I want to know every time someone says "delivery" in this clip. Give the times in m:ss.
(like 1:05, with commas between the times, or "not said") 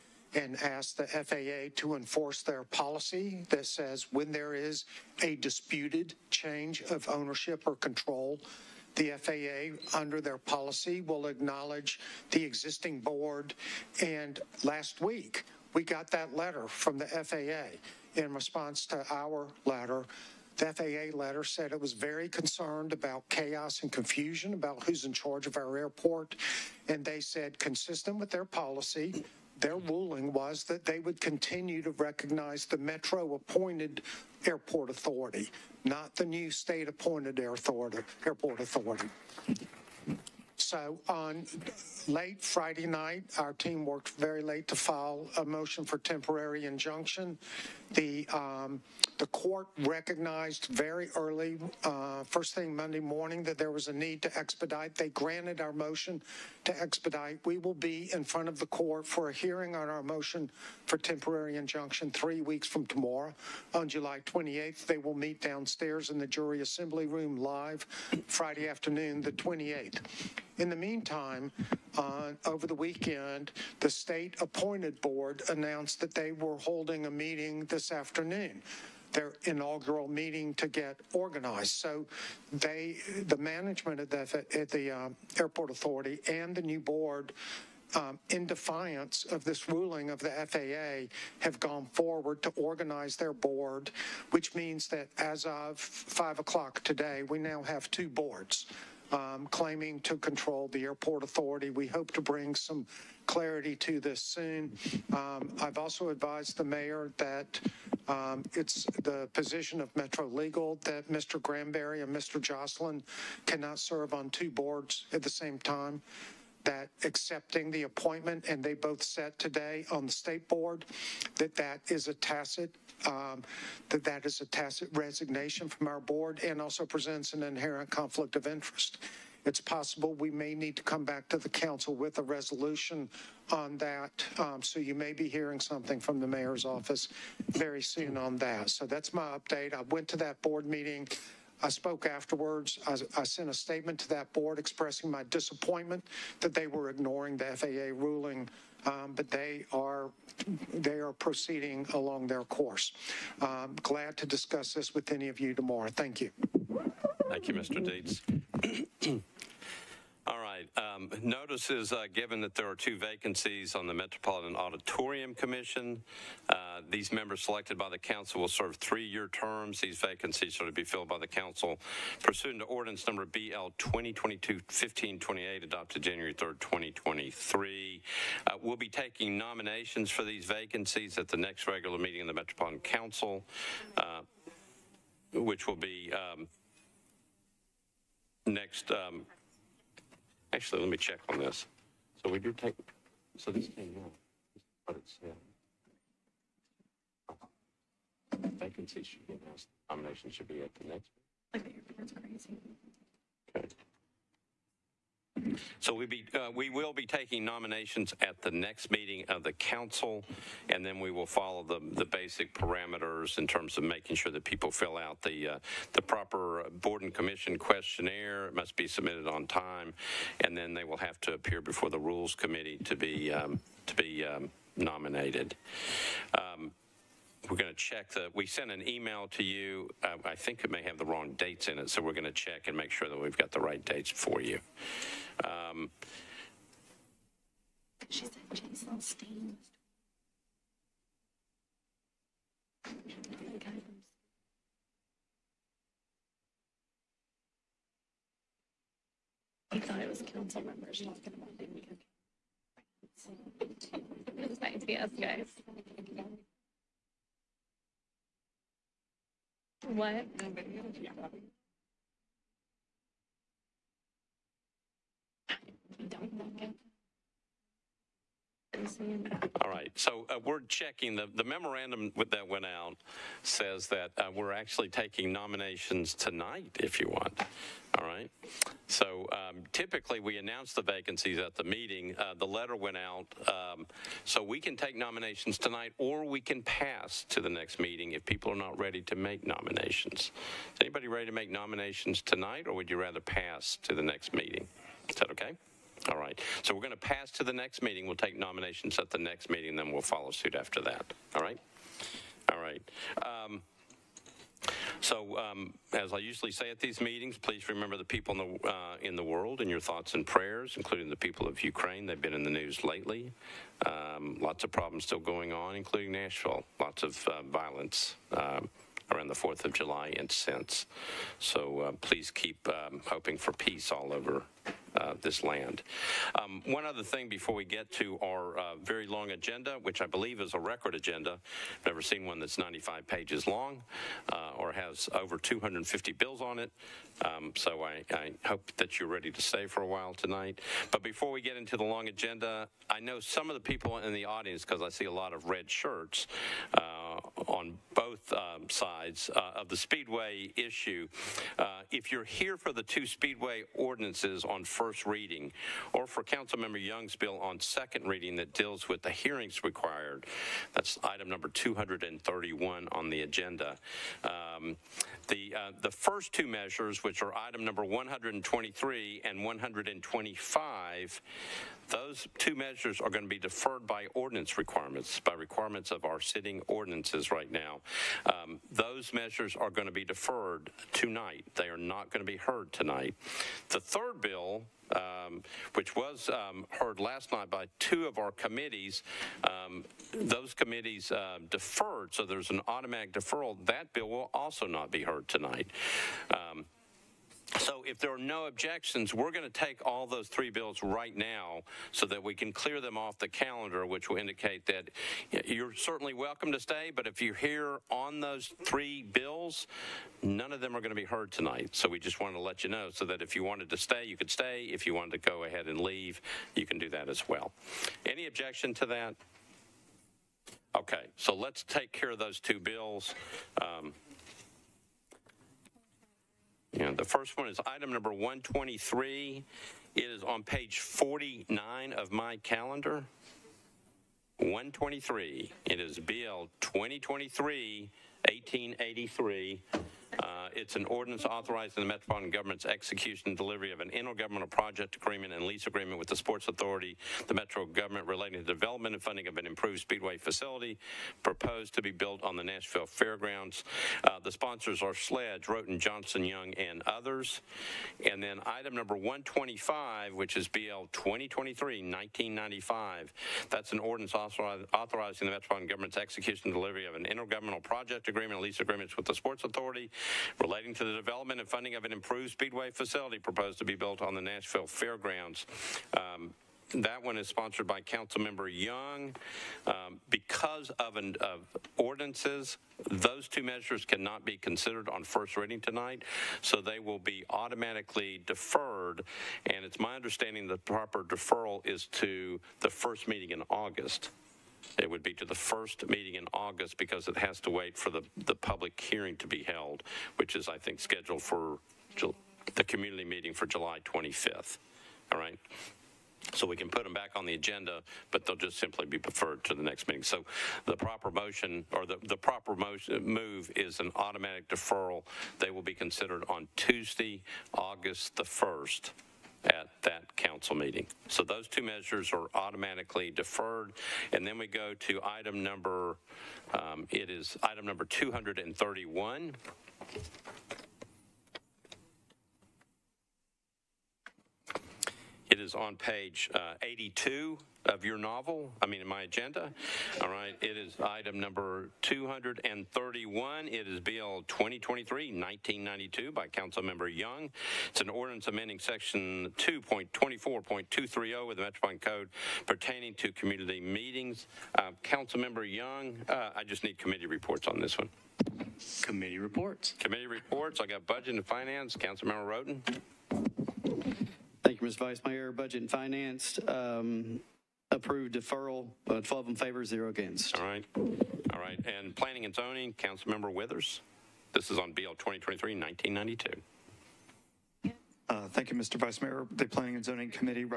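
7:23, 7:46.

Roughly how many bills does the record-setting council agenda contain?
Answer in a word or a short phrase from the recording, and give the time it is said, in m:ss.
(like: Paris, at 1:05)
over 250, at 5:35.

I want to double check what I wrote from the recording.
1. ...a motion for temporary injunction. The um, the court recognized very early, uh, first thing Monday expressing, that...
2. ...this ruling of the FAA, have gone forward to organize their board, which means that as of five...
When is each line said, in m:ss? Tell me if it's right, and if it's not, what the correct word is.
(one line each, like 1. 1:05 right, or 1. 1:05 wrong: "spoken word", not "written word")
1. 0:45 wrong: "morning", not "expressing"
2. 1:29 right.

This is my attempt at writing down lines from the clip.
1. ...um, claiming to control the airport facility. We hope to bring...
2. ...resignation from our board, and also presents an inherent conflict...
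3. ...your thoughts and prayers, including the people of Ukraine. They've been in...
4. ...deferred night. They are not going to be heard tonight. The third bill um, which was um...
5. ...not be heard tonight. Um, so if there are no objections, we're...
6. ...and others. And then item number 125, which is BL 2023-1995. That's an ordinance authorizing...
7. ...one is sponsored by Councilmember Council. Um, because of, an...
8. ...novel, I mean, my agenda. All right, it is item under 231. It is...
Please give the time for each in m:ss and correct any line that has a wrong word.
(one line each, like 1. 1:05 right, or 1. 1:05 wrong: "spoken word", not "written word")
1. 1:39 wrong: "authority", not "facility"
2. 2:04 right
3. 5:09 right
4. 6:20 wrong: "tonight", not "night"
5. 6:34 right
6. 7:36 right
7. 7:57 wrong: "Young", not "Council"
8. 8:57 wrong: "number", not "under".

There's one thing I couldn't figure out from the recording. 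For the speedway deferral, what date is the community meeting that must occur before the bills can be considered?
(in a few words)
July 25th.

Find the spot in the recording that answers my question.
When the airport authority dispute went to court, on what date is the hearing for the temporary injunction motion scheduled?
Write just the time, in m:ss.
1:03.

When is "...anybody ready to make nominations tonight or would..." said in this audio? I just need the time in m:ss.
4:50.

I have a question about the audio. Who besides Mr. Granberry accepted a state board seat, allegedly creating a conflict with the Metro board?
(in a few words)
Mr. Jocelyn.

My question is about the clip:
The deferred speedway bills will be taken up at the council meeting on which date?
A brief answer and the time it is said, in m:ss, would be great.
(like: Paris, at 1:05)
August 1st, at 8:37.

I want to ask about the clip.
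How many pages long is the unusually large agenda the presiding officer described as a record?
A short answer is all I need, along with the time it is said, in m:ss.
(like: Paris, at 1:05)
95, at 5:32.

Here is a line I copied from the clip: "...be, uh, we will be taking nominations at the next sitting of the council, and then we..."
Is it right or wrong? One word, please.
wrong.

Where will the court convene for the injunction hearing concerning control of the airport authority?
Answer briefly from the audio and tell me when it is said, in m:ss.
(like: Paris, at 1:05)
jury assembly room, at 1:06.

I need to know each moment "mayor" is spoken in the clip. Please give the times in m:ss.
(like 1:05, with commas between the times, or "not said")
1:46, 2:16, 9:25, 9:39.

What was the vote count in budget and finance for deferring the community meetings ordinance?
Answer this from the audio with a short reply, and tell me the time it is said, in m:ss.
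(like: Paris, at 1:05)
12 to 0, at 9:29.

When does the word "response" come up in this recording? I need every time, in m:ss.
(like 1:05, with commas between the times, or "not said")
0:18.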